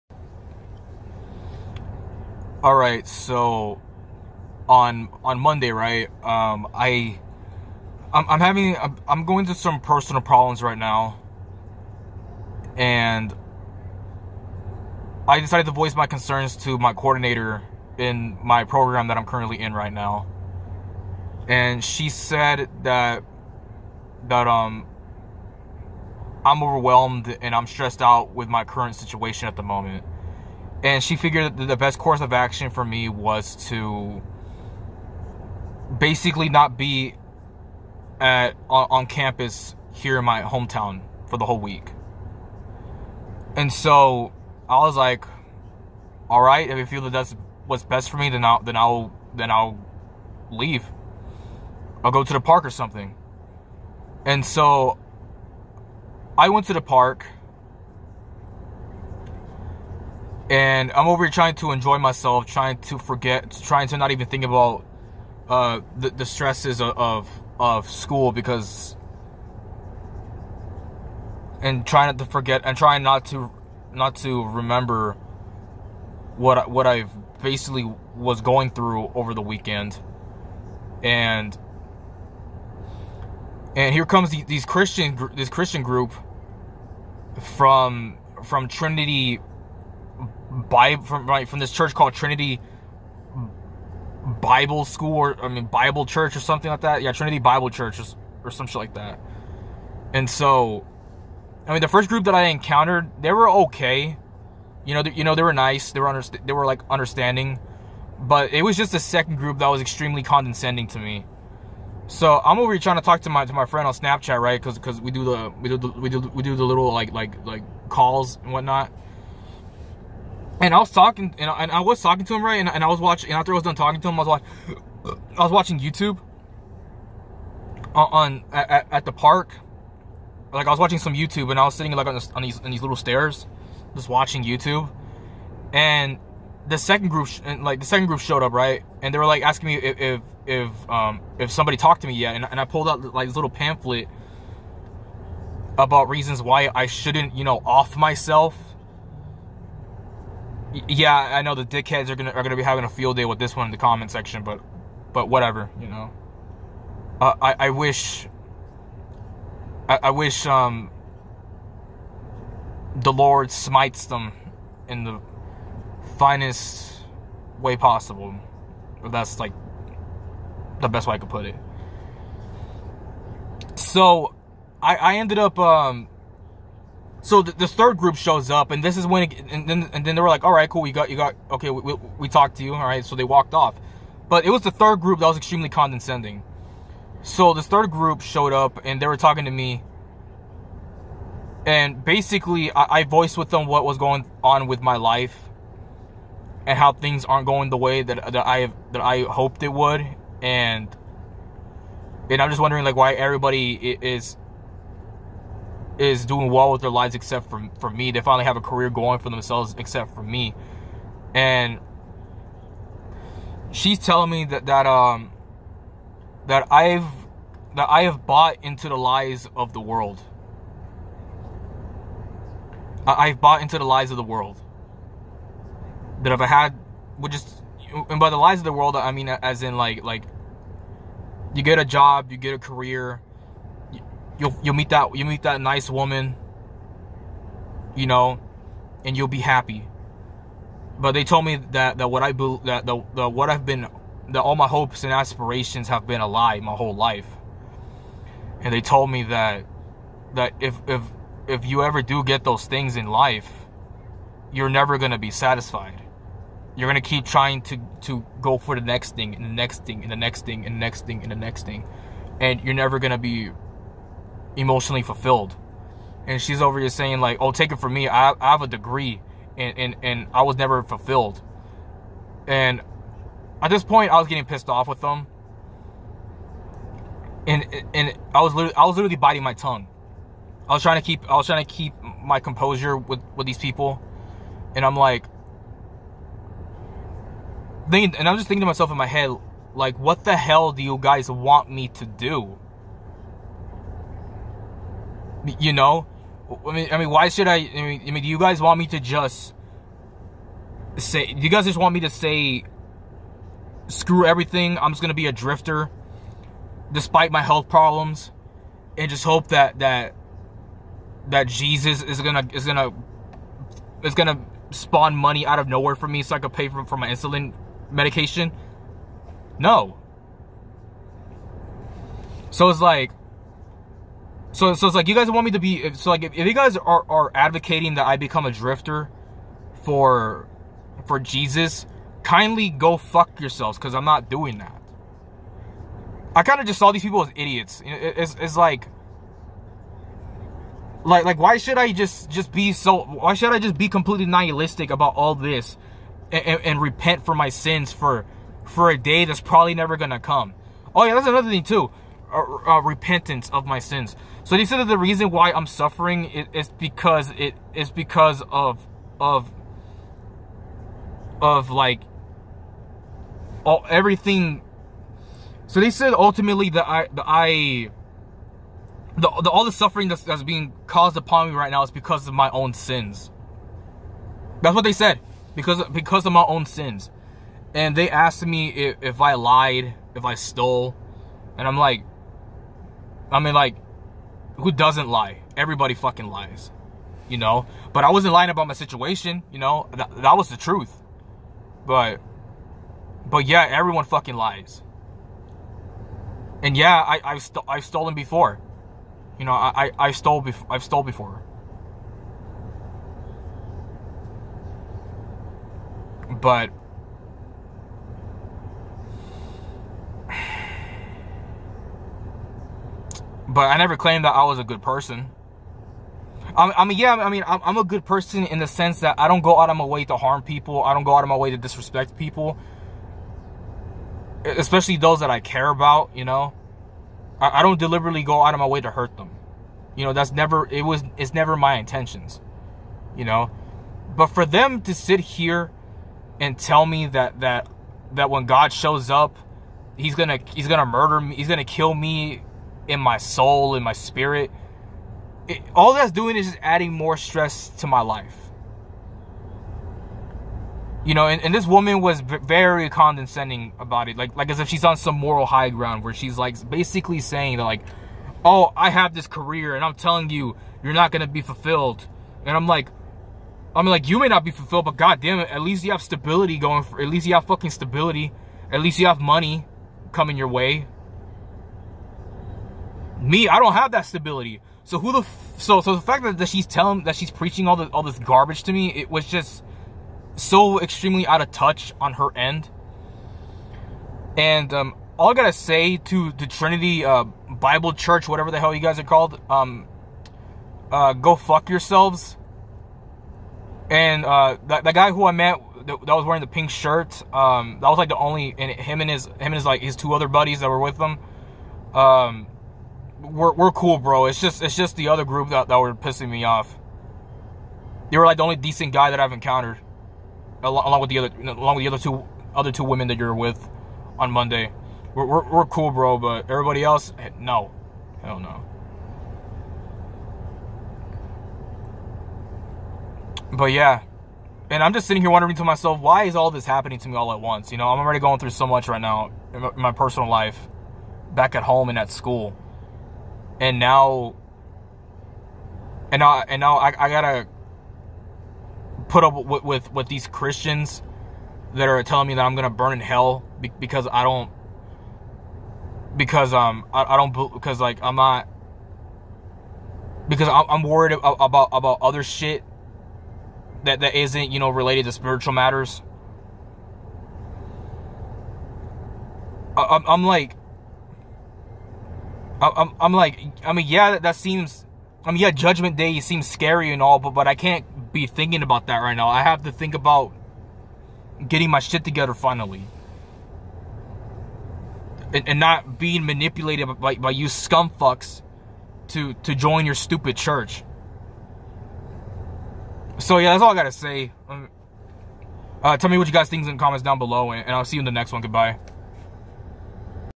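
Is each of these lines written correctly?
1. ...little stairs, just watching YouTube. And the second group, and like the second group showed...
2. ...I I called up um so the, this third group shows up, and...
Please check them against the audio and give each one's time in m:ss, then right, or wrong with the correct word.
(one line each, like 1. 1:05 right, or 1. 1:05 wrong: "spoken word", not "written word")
1. 2:12 right
2. 2:54 wrong: "ended", not "called".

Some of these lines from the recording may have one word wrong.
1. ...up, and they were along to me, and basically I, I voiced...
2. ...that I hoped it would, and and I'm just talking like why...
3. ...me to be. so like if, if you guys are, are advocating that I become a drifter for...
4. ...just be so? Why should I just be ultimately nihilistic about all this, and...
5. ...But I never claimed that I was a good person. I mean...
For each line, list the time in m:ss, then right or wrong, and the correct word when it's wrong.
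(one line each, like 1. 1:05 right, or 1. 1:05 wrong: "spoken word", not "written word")
1. 3:08 wrong: "talking", not "along"
2. 3:18 wrong: "wondering", not "talking"
3. 5:25 right
4. 5:42 wrong: "completely", not "ultimately"
5. 6:53 right.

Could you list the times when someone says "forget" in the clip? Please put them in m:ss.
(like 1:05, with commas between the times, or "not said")
1:02, 1:12.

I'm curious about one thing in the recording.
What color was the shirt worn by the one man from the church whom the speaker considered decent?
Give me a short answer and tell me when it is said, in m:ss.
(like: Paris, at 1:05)
pink, at 8:16.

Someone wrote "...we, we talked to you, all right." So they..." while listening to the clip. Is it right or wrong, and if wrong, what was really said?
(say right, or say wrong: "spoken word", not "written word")
right.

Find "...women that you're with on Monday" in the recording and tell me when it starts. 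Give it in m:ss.
8:32.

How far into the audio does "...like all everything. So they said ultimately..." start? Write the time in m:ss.
6:01.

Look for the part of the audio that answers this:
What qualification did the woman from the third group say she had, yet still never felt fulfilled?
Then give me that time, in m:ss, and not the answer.
4:28.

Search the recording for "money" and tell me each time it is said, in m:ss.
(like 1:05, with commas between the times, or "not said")
5:15, 7:49.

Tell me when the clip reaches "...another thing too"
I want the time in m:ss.
5:51.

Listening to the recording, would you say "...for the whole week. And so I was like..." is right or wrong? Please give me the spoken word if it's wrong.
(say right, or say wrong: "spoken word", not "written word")
right.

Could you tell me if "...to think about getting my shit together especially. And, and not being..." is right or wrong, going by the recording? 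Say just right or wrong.
wrong.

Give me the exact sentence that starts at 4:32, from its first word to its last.
And at this point, I was getting pissed off with them.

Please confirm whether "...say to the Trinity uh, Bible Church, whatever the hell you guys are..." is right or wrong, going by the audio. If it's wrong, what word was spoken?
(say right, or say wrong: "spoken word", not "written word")
right.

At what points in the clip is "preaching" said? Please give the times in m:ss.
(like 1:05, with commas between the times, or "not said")
7:57.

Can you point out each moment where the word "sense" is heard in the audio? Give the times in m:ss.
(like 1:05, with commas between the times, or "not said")
6:58.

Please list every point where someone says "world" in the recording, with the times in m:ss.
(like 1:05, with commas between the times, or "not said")
3:39, 3:44, 3:48.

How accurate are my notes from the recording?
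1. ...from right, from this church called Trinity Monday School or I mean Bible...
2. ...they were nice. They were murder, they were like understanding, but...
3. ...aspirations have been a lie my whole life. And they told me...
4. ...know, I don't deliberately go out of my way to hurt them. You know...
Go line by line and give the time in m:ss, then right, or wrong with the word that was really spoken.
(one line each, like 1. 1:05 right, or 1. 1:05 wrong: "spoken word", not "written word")
1. 1:31 wrong: "Bible", not "Monday"
2. 1:45 wrong: "under", not "murder"
3. 4:05 right
4. 7:06 right.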